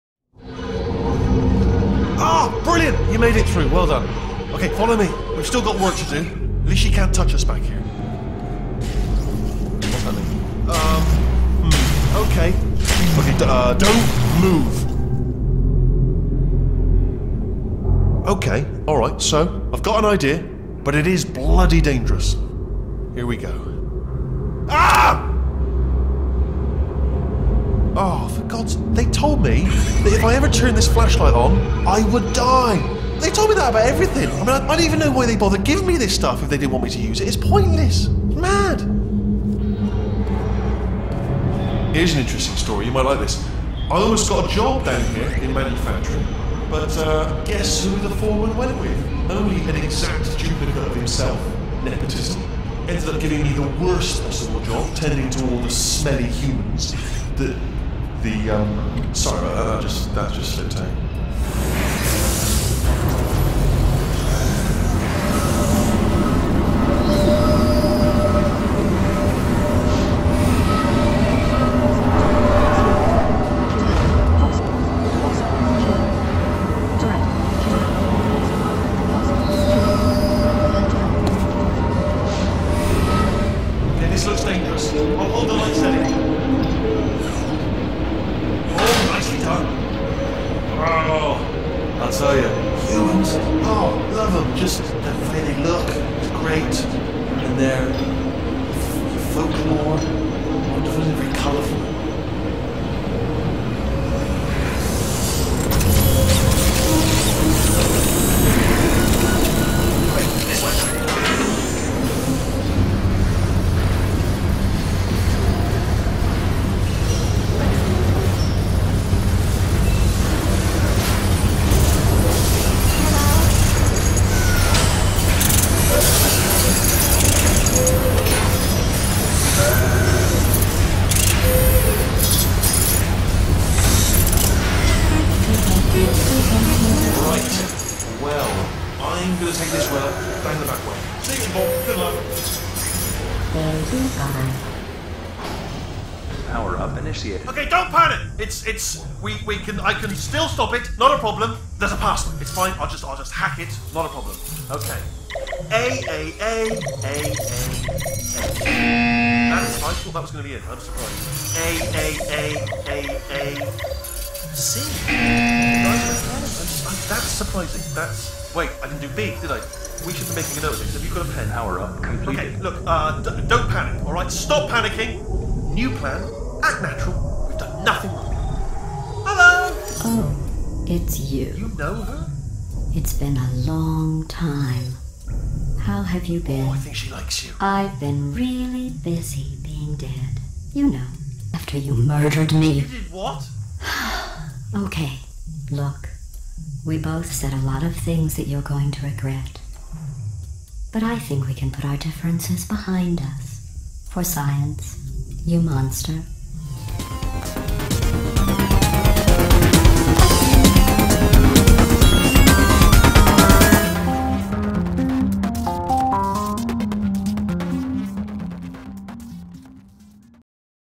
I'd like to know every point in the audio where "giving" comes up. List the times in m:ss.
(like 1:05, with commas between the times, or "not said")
0:35, 0:53.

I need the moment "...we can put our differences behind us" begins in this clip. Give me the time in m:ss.
3:21.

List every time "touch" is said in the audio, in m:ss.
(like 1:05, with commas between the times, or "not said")
0:07.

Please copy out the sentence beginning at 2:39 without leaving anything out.
That is, I thought that was going to be it.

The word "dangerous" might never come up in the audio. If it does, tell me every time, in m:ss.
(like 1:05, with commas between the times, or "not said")
0:21, 1:24.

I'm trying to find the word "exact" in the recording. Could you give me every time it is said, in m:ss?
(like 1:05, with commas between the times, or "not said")
0:49.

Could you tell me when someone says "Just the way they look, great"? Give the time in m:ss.
1:34.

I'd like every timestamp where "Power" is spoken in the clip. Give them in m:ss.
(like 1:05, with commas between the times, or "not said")
2:26, 2:51.